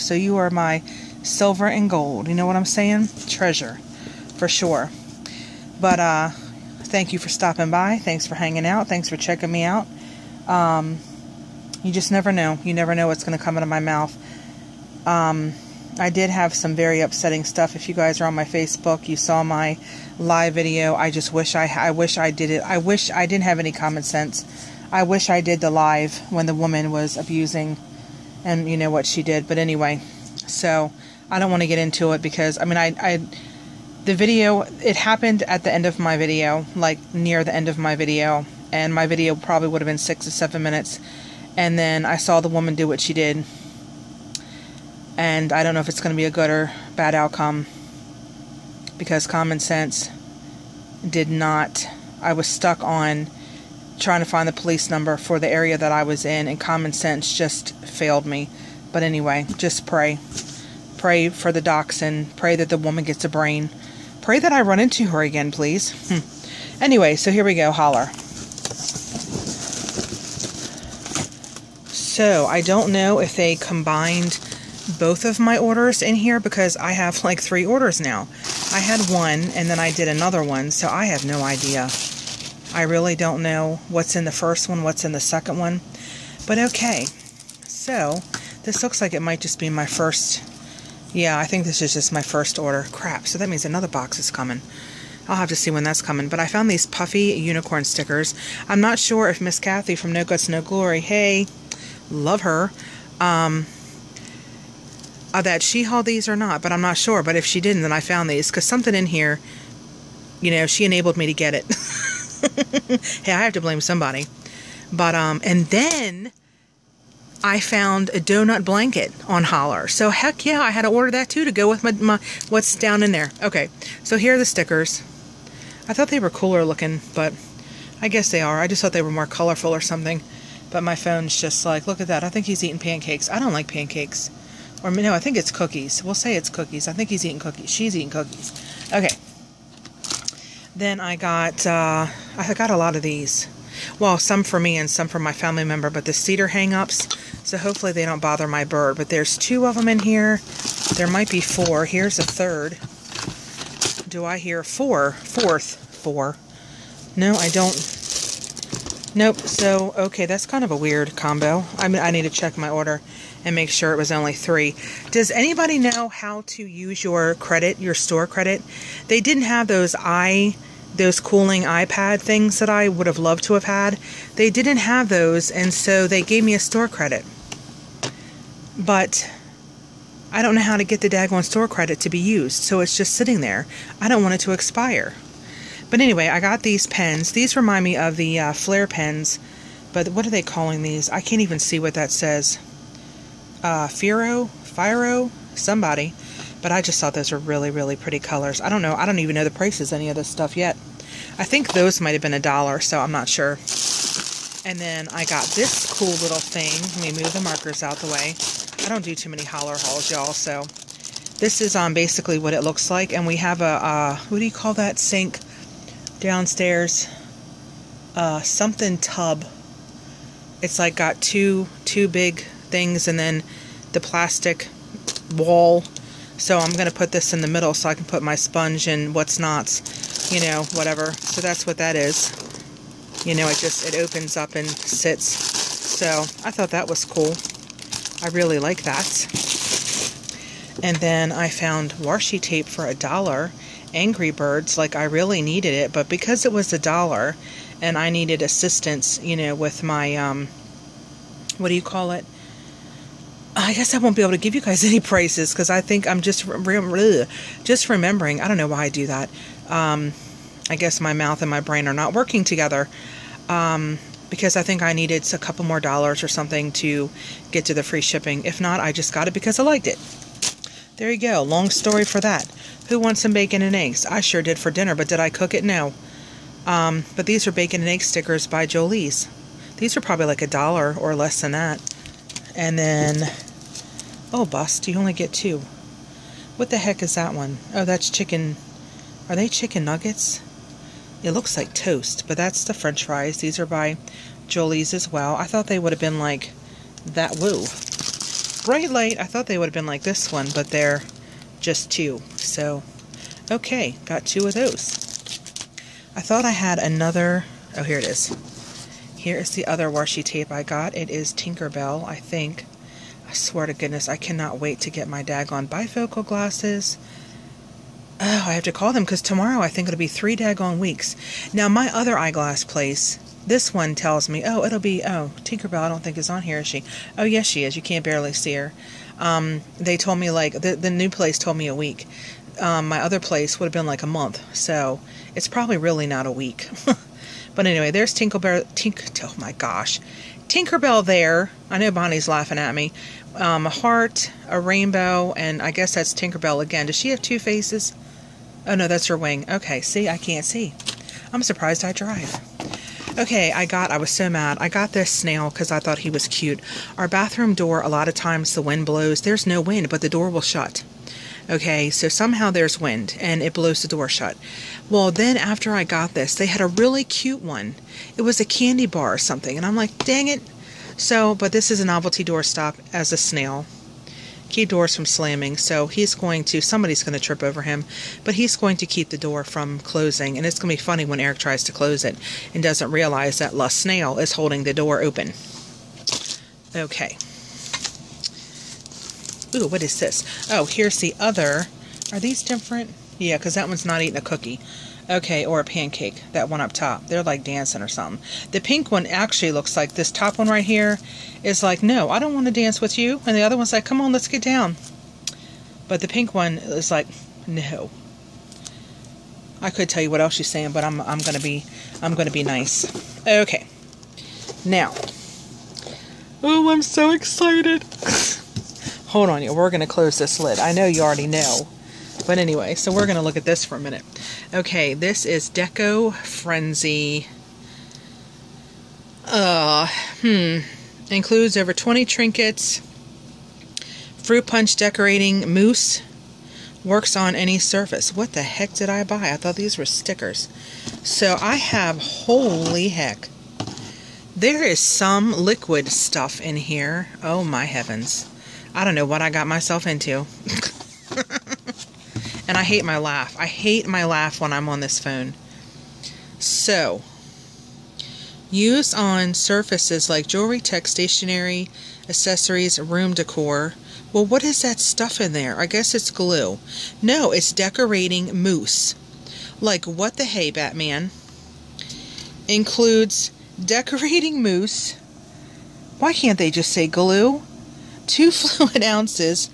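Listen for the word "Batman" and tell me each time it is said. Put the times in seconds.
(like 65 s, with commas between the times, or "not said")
470 s.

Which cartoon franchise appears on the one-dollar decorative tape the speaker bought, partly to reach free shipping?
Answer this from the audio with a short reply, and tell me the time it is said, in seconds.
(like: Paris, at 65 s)
Angry Birds, at 243 s.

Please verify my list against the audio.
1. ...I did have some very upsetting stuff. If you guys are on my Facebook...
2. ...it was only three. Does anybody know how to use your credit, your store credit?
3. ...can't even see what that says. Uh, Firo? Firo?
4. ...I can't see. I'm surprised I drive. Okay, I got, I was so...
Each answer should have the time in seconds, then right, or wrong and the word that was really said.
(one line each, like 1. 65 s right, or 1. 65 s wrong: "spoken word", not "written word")
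1. 15 s right
2. 163 s right
3. 191 s right
4. 350 s right.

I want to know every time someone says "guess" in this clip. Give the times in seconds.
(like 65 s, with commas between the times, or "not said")
128 s, 253 s, 260 s, 345 s, 465 s.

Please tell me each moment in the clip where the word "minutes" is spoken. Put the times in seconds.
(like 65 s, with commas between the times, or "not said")
40 s, 423 s.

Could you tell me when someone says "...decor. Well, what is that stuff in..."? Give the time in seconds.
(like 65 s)
463 s.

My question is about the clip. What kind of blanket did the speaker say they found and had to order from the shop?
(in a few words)
Donut blanket.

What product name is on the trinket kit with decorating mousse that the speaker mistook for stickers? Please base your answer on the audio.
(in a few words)
Deco Frenzy.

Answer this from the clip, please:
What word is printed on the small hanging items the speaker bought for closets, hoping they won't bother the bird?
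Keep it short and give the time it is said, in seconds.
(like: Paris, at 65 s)
Cedar, at 146 s.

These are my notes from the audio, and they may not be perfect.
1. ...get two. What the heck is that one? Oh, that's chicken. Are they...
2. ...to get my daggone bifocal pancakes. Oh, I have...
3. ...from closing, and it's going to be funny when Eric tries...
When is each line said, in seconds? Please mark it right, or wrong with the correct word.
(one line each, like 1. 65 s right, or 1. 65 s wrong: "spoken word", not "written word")
1. 285 s right
2. 314 s wrong: "glasses", not "pancakes"
3. 379 s right.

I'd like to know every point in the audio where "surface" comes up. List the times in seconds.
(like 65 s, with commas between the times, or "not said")
437 s, 459 s.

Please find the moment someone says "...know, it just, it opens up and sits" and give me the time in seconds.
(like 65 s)
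233 s.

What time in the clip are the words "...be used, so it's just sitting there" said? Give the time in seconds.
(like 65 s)
182 s.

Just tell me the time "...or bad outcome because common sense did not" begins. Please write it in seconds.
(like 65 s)
46 s.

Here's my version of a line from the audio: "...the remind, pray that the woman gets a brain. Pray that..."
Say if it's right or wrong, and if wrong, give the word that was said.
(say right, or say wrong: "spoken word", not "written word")
wrong: "dachshund", not "remind".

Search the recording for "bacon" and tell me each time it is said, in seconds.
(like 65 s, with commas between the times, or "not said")
273 s, 277 s.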